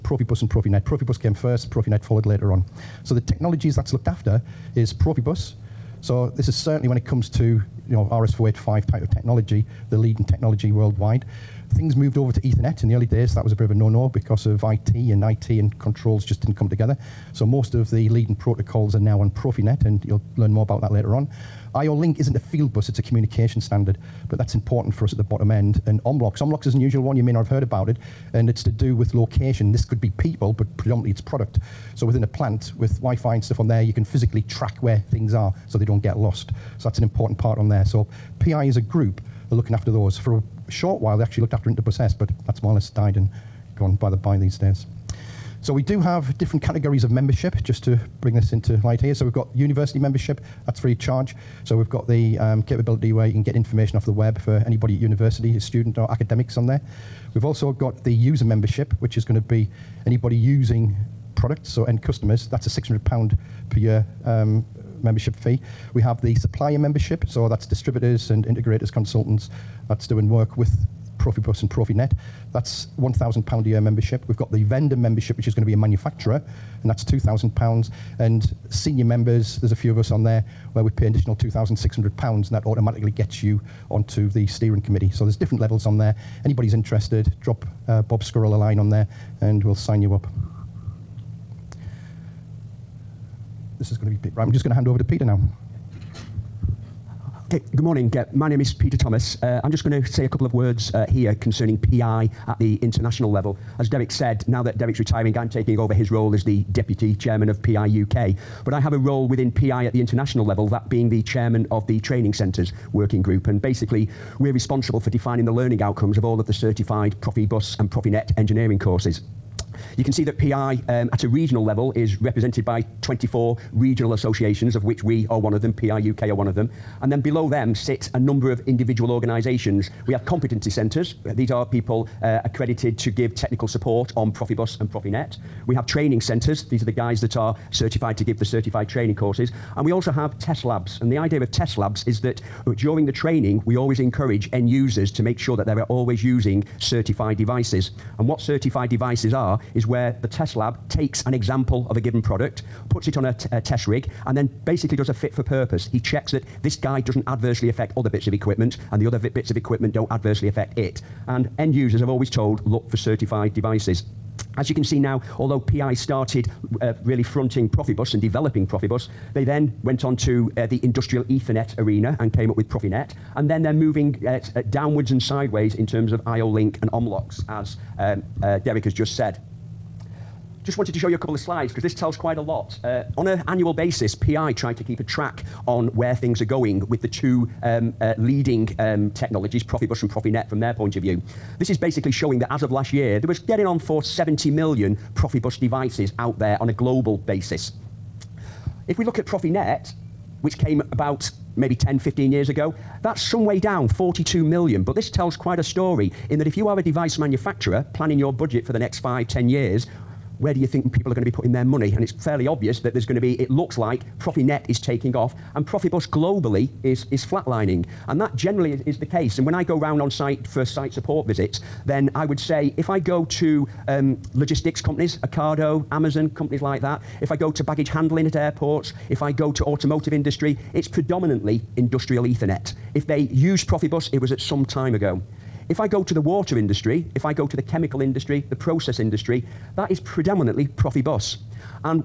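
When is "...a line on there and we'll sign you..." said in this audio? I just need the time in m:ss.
1:28.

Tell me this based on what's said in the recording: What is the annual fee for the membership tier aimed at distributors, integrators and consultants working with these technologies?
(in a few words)
£1,000.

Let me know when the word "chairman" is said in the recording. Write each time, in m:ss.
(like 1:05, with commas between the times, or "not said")
1:47, 1:51.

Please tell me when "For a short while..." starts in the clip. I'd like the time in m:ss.
0:40.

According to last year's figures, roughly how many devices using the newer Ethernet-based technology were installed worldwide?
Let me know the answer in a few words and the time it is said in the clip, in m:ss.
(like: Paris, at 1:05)
42 million, at 3:23.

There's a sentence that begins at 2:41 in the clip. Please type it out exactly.
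And end users have always told look for certified devices.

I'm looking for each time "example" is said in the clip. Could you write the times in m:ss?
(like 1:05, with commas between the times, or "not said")
2:31.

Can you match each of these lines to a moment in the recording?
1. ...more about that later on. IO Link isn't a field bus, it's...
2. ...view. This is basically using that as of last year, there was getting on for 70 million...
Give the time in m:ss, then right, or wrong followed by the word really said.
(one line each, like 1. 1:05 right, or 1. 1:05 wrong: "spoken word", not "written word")
1. 0:20 right
2. 3:11 wrong: "showing", not "using".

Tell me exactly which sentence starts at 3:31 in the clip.
And it's fairly obvious that there's going to be, it looks like, ProfiNet is taking off, and Profibus globally is, is flatlining.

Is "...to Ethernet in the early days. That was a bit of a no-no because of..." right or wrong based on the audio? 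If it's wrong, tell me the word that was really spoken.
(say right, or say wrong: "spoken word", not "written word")
right.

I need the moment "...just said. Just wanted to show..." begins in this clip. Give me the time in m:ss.
2:58.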